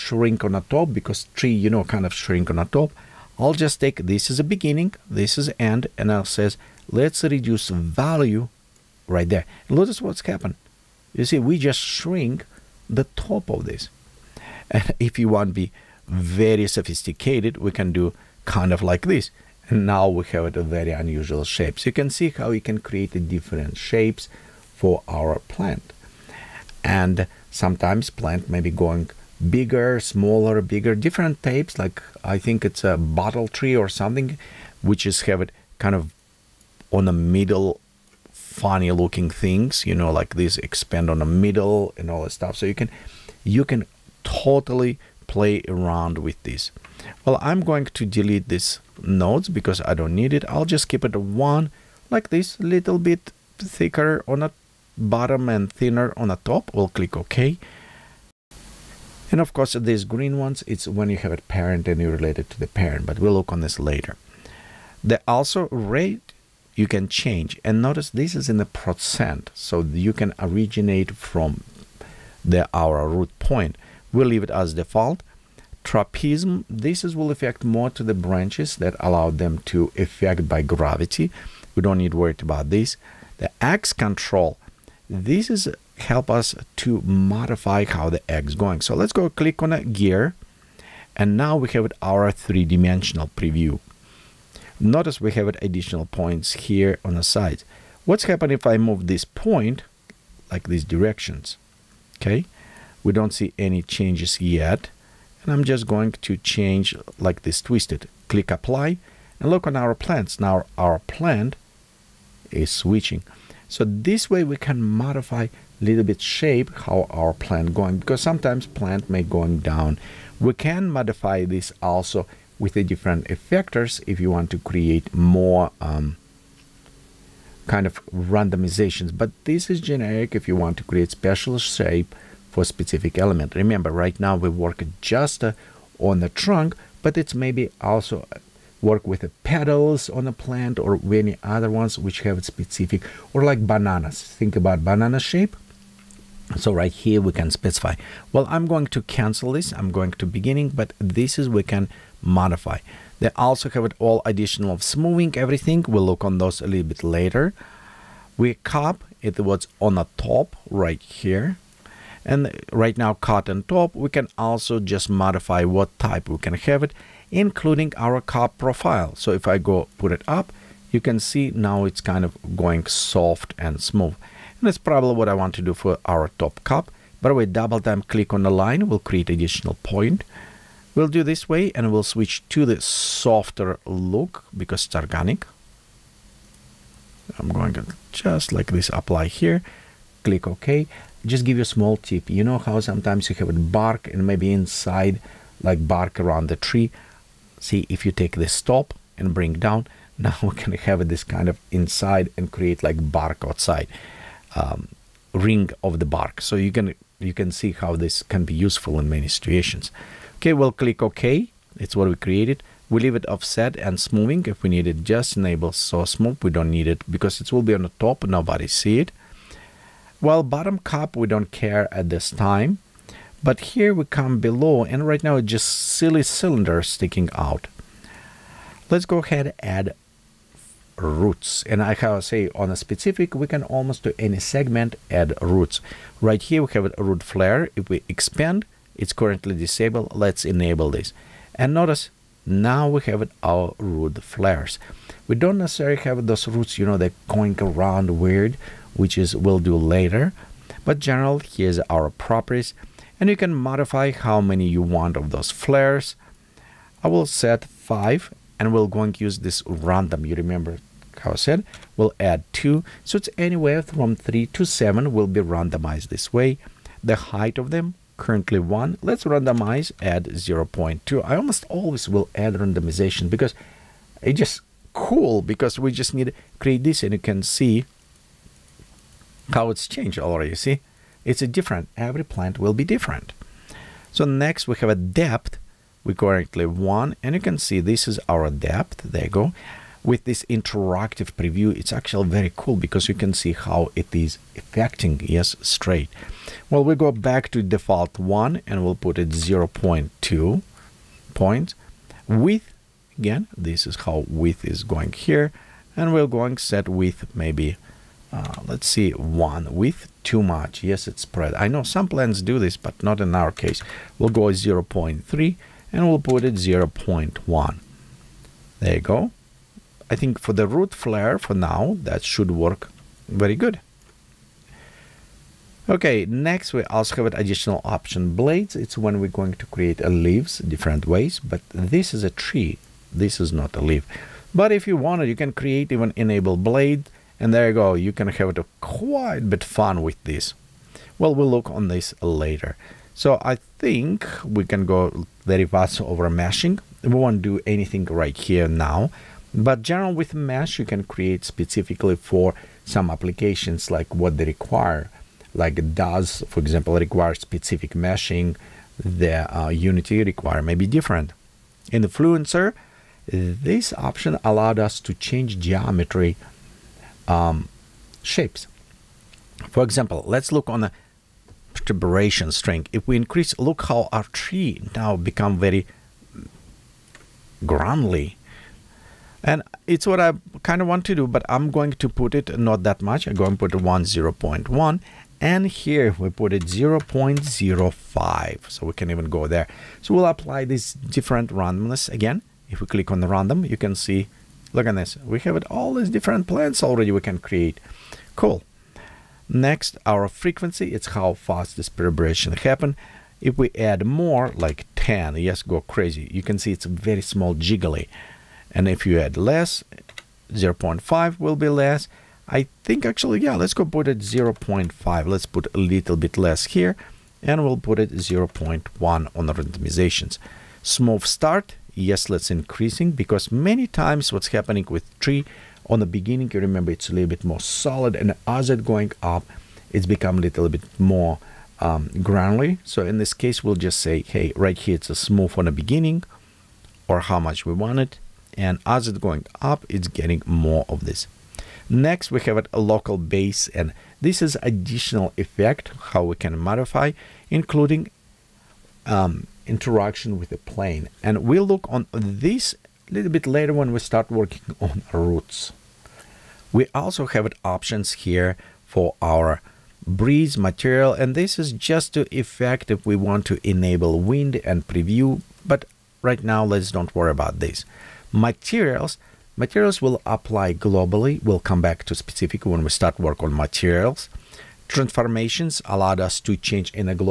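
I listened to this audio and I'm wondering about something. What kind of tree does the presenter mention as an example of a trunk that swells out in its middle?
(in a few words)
bottle tree.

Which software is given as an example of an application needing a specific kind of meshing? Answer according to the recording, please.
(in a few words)
Daz.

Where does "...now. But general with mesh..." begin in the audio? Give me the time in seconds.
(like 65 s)
348 s.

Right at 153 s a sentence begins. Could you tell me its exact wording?
They also have it all additional of smoothing everything.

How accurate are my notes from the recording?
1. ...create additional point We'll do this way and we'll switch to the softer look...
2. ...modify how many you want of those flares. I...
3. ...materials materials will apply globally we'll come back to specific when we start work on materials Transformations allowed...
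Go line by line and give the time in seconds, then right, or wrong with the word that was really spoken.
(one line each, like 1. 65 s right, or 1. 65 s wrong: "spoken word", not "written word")
1. 179 s right
2. 253 s right
3. 468 s right.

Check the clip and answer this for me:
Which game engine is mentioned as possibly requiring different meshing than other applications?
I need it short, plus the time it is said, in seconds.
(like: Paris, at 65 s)
Unity, at 359 s.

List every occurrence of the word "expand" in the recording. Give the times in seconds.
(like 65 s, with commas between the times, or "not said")
40 s, 238 s.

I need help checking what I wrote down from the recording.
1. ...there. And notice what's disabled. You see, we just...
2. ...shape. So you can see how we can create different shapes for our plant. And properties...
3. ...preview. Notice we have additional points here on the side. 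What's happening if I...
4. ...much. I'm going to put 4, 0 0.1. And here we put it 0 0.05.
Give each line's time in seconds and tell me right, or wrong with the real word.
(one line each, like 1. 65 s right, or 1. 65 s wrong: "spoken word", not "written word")
1. 9 s wrong: "happened", not "disabled"
2. 21 s wrong: "sometimes", not "properties"
3. 93 s right
4. 383 s wrong: "1", not "4".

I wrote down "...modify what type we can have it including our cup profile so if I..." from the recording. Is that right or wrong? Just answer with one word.
right.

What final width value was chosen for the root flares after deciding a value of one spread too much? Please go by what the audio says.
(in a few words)
0.3.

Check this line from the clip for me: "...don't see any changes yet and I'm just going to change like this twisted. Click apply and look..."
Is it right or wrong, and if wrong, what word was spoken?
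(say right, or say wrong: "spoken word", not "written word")
right.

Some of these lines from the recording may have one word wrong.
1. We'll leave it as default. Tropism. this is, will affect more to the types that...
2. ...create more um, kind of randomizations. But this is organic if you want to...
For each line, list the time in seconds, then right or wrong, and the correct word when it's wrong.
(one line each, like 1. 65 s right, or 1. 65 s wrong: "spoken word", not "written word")
1. 74 s wrong: "branches", not "types"
2. 124 s wrong: "generic", not "organic".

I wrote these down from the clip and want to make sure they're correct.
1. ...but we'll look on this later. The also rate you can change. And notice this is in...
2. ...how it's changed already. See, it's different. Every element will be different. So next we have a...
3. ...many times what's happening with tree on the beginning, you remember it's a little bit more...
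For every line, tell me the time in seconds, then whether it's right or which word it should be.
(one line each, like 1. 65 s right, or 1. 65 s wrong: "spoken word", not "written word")
1. 63 s right
2. 279 s wrong: "plant", not "element"
3. 423 s right.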